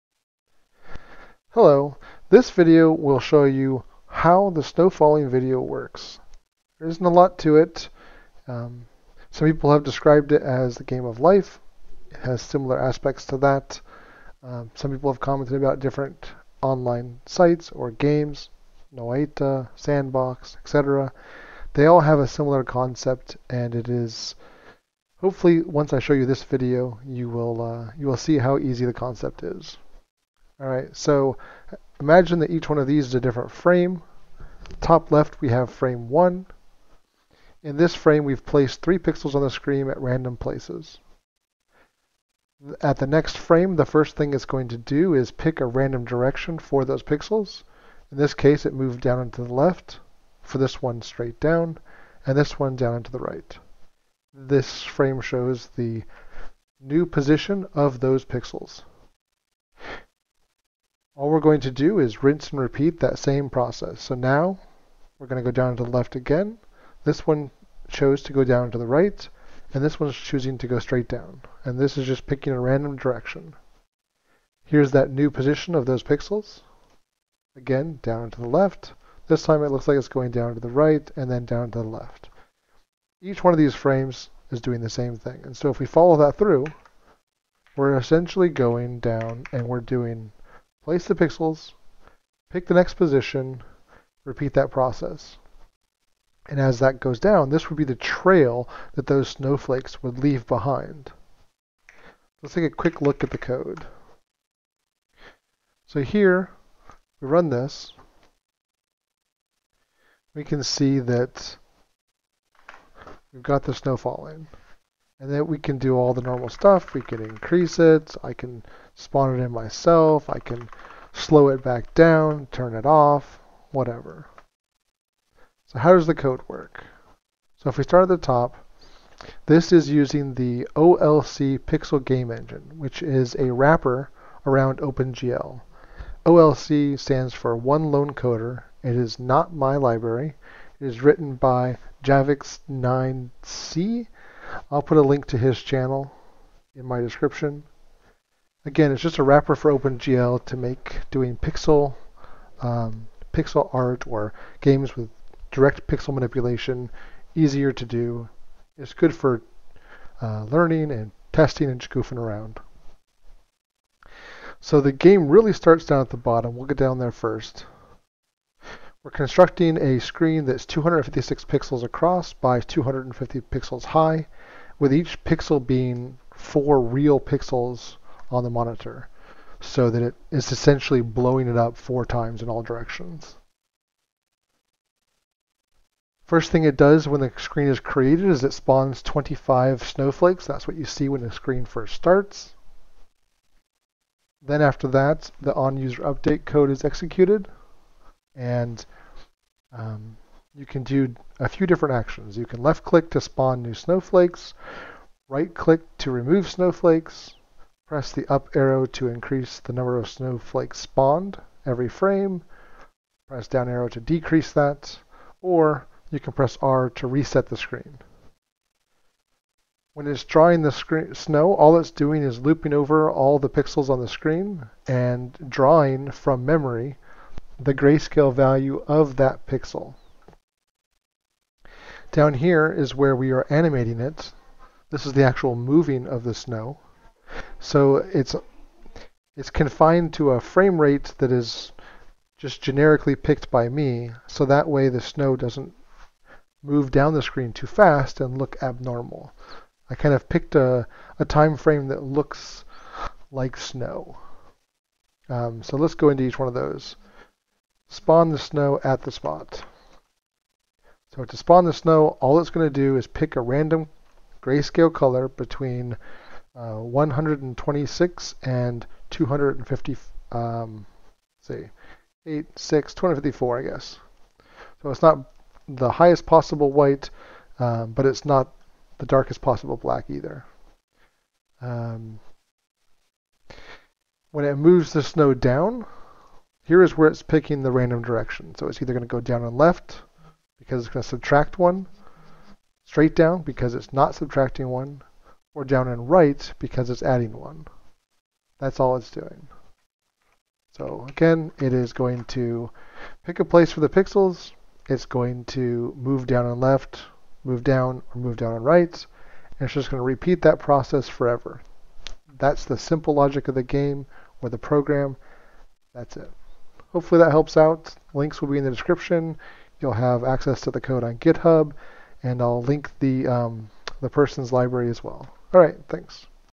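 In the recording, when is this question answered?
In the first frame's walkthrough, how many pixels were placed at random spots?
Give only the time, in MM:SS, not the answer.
00:38.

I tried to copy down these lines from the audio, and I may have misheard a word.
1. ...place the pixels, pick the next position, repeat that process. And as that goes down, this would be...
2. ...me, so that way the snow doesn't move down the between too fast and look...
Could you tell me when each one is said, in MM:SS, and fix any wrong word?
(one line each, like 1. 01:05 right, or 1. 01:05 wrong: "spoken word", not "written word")
1. 01:30 right
2. 04:03 wrong: "screen", not "between".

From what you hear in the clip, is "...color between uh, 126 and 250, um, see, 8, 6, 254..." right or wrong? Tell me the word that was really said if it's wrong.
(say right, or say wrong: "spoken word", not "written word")
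right.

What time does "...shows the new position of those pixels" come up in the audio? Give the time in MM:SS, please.
00:55.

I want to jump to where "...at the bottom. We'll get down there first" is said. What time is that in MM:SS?
02:45.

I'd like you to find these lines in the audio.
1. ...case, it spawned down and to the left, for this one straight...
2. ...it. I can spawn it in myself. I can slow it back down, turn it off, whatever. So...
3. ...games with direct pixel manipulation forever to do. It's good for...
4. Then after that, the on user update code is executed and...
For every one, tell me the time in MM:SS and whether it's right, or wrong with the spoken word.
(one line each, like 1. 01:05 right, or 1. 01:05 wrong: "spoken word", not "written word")
1. 00:48 wrong: "moved", not "spawned"
2. 01:57 right
3. 02:34 wrong: "easier", not "forever"
4. 03:14 right.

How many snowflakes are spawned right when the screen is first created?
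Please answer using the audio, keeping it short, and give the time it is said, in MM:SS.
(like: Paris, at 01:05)
25, at 03:09.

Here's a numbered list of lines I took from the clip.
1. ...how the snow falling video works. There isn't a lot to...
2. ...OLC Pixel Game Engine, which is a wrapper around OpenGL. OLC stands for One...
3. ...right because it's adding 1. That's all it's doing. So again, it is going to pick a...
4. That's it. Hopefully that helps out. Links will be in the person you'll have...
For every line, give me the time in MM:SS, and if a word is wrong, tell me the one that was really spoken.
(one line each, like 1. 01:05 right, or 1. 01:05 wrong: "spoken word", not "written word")
1. 00:04 right
2. 02:10 right
3. 04:56 right
4. 05:15 wrong: "description", not "person".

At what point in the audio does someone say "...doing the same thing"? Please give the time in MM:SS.
01:24.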